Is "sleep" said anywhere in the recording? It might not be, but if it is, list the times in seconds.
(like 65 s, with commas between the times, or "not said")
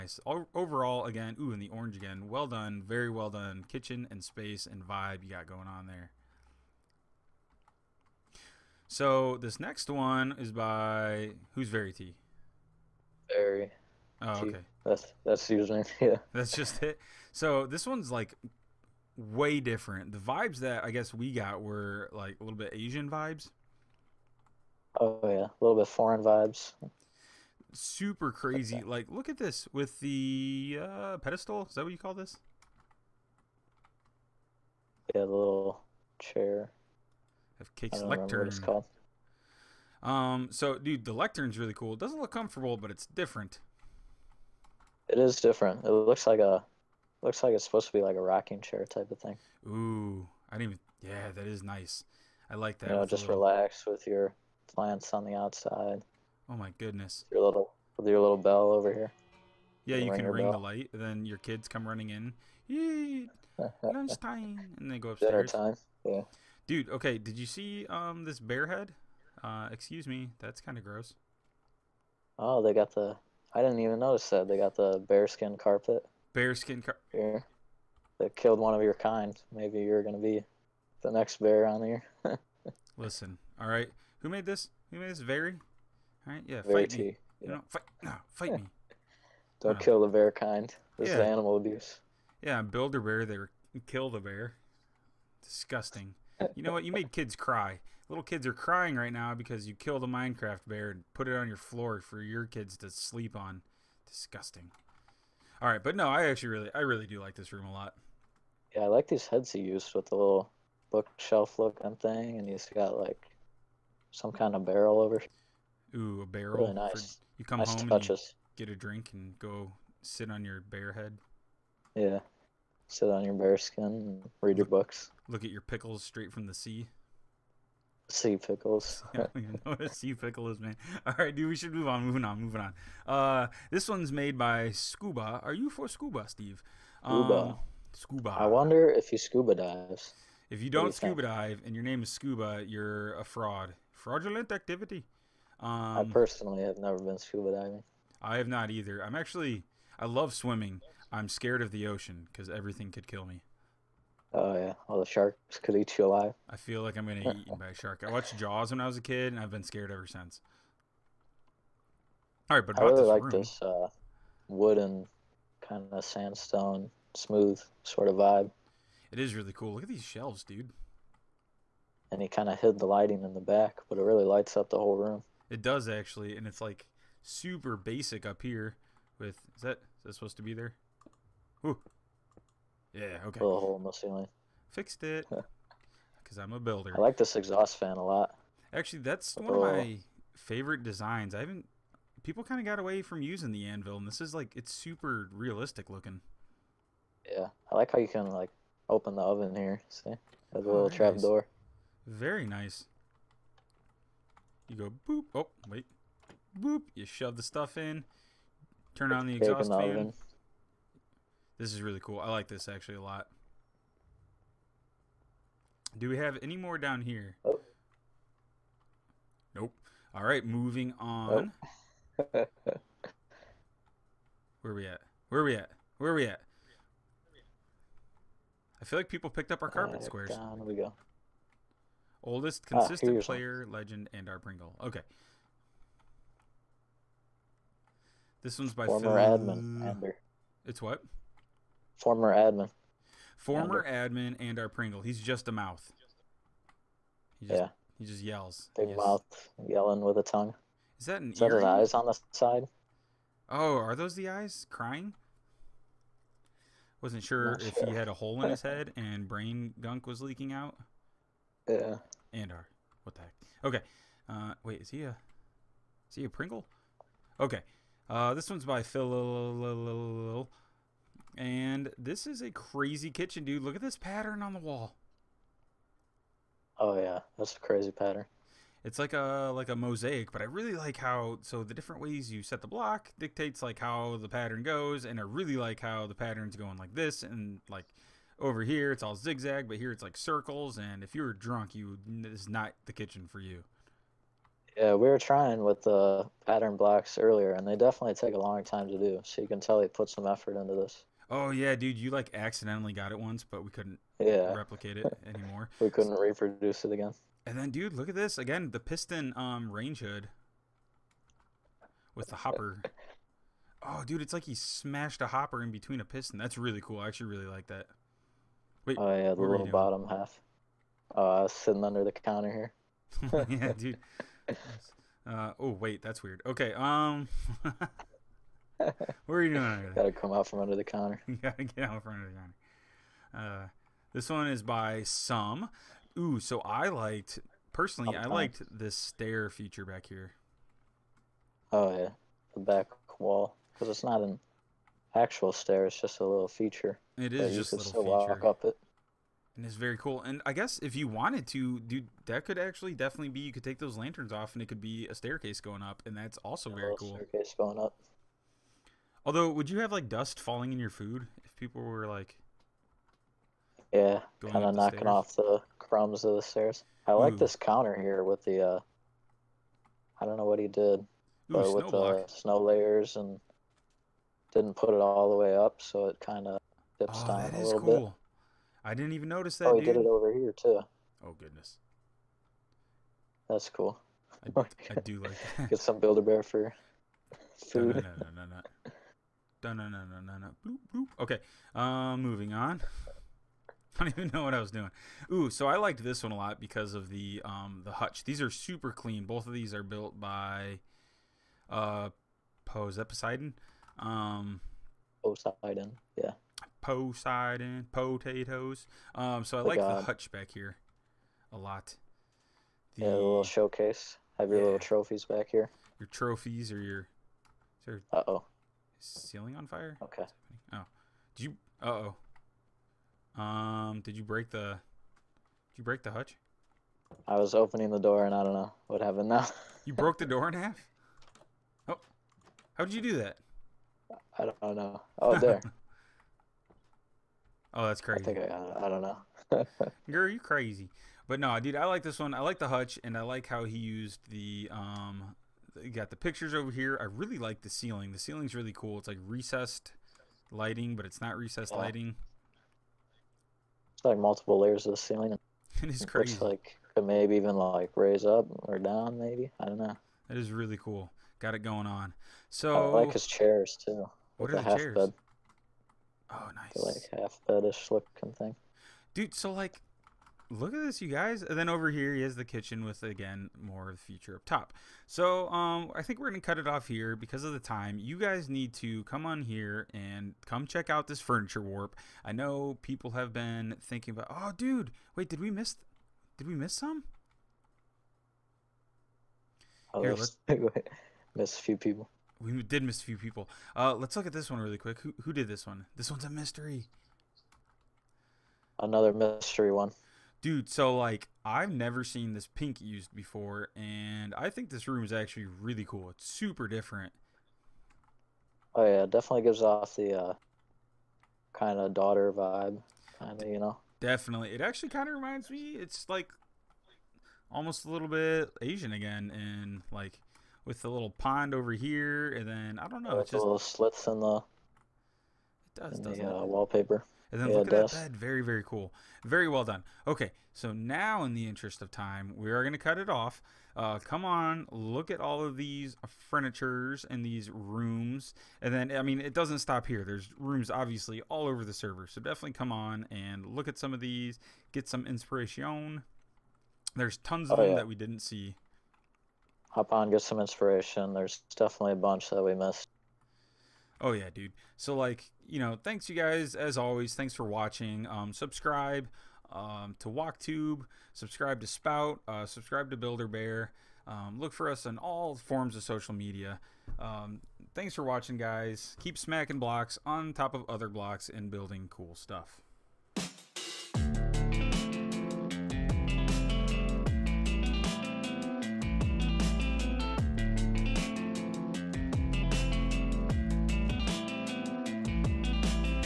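102 s.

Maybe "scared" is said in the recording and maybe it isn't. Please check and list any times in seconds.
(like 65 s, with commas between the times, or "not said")
151 s, 159 s.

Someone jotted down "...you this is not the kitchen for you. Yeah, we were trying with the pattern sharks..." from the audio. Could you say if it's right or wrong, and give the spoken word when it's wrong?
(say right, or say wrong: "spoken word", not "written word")
wrong: "blocks", not "sharks".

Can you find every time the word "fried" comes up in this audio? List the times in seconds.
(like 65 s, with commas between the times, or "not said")
not said.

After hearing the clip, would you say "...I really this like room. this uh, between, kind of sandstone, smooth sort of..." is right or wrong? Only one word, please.
wrong.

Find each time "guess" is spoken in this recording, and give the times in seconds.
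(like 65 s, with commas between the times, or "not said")
20 s, 350 s.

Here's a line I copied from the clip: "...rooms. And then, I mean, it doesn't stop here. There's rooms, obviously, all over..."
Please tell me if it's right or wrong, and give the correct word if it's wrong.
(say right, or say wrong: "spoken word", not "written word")
right.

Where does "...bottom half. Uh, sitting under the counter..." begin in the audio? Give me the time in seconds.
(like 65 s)
319 s.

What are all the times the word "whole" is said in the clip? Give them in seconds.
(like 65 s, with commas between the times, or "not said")
174 s.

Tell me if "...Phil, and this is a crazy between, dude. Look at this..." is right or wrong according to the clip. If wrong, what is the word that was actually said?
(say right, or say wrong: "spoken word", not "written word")
wrong: "kitchen", not "between".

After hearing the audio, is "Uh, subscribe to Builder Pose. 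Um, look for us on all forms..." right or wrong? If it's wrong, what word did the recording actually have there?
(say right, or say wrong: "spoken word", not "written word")
wrong: "Bear", not "Pose".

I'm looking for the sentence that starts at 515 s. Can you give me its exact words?
It's like almost a little bit Asian again, and like with the little pond over here, and then I don't know.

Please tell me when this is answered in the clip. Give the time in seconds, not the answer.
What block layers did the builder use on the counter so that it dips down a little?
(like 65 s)
372 s.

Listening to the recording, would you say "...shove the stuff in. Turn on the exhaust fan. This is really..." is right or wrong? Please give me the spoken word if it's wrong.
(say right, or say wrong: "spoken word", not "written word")
right.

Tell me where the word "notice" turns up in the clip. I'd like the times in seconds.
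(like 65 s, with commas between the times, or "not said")
73 s, 379 s.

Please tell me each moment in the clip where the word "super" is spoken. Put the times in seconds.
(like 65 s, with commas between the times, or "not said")
27 s, 177 s, 194 s, 398 s, 506 s.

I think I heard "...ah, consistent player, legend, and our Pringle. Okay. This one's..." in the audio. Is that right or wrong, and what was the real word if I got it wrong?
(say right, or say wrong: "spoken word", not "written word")
right.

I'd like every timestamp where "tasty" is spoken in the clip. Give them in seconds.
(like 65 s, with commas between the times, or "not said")
not said.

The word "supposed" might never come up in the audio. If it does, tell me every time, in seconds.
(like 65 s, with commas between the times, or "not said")
47 s, 180 s.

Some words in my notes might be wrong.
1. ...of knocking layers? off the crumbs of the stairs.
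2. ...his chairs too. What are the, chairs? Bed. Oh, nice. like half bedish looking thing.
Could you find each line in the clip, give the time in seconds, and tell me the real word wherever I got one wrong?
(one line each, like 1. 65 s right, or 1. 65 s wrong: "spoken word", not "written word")
1. 364 s wrong: "stairs", not "layers"
2. 463 s right.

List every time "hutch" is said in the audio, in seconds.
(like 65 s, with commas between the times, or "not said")
397 s, 410 s, 426 s, 442 s.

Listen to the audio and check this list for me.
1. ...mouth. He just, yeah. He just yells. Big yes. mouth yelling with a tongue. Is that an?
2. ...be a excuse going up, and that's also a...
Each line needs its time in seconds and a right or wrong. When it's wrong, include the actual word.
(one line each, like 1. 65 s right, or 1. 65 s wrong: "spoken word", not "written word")
1. 245 s right
2. 354 s wrong: "staircase", not "excuse".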